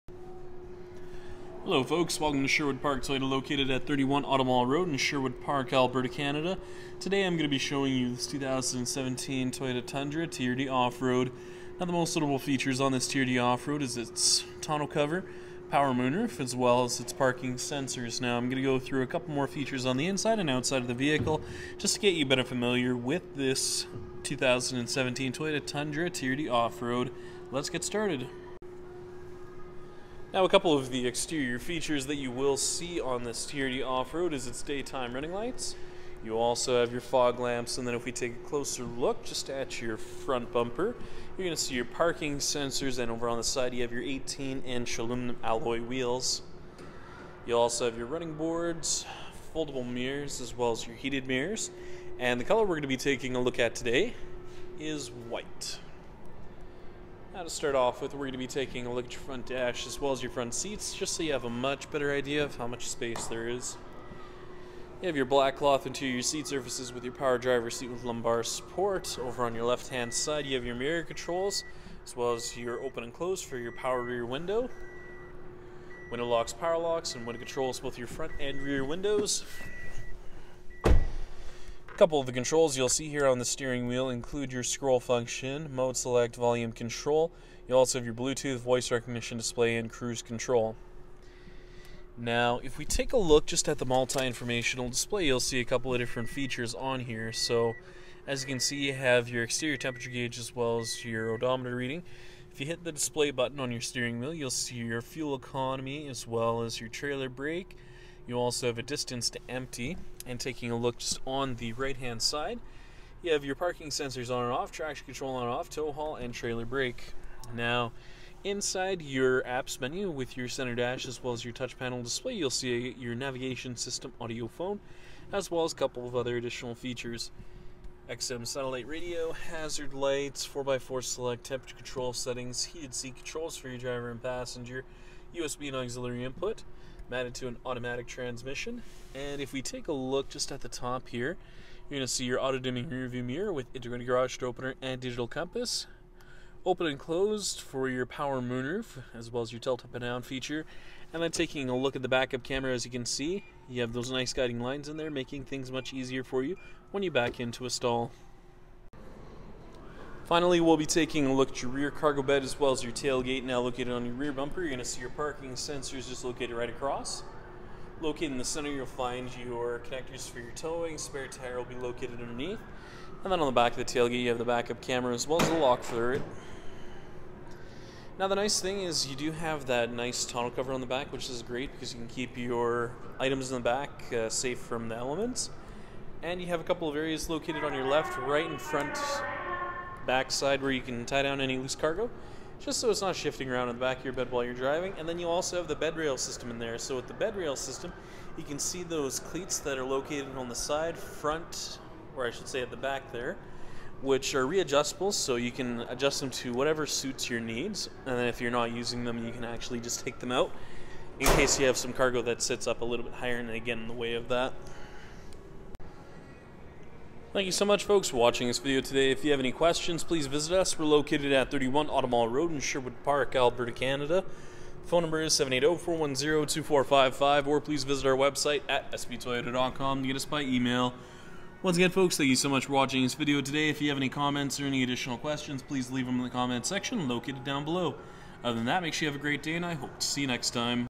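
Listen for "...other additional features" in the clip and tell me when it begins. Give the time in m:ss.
2:06.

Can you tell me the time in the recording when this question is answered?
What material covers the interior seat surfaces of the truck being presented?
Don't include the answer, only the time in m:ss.
1:05.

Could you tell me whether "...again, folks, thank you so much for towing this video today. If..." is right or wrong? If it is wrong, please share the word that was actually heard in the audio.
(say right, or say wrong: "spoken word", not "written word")
wrong: "watching", not "towing".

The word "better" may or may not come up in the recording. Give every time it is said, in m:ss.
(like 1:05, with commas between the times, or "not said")
0:22, 1:01.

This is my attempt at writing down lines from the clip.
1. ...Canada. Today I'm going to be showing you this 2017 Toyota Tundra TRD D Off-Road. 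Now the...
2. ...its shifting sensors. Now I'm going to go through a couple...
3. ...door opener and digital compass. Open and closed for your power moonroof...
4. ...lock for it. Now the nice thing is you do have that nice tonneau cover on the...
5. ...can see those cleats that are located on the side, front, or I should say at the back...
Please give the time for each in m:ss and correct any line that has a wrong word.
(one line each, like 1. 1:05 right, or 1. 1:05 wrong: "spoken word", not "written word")
1. 0:06 right
2. 0:16 wrong: "parking", not "shifting"
3. 2:24 right
4. 2:55 right
5. 3:18 right.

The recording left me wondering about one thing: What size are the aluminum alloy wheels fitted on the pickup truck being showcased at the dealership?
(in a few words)
18 inch.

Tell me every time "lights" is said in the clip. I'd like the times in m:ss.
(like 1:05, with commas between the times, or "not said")
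0:35, 2:09.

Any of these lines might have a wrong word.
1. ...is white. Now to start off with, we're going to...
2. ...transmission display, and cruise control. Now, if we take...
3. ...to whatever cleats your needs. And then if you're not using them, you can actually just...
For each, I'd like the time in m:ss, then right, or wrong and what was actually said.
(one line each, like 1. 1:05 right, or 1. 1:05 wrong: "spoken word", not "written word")
1. 0:54 right
2. 1:28 wrong: "recognition", not "transmission"
3. 3:26 wrong: "suits", not "cleats".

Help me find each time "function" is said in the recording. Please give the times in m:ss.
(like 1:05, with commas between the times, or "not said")
1:24.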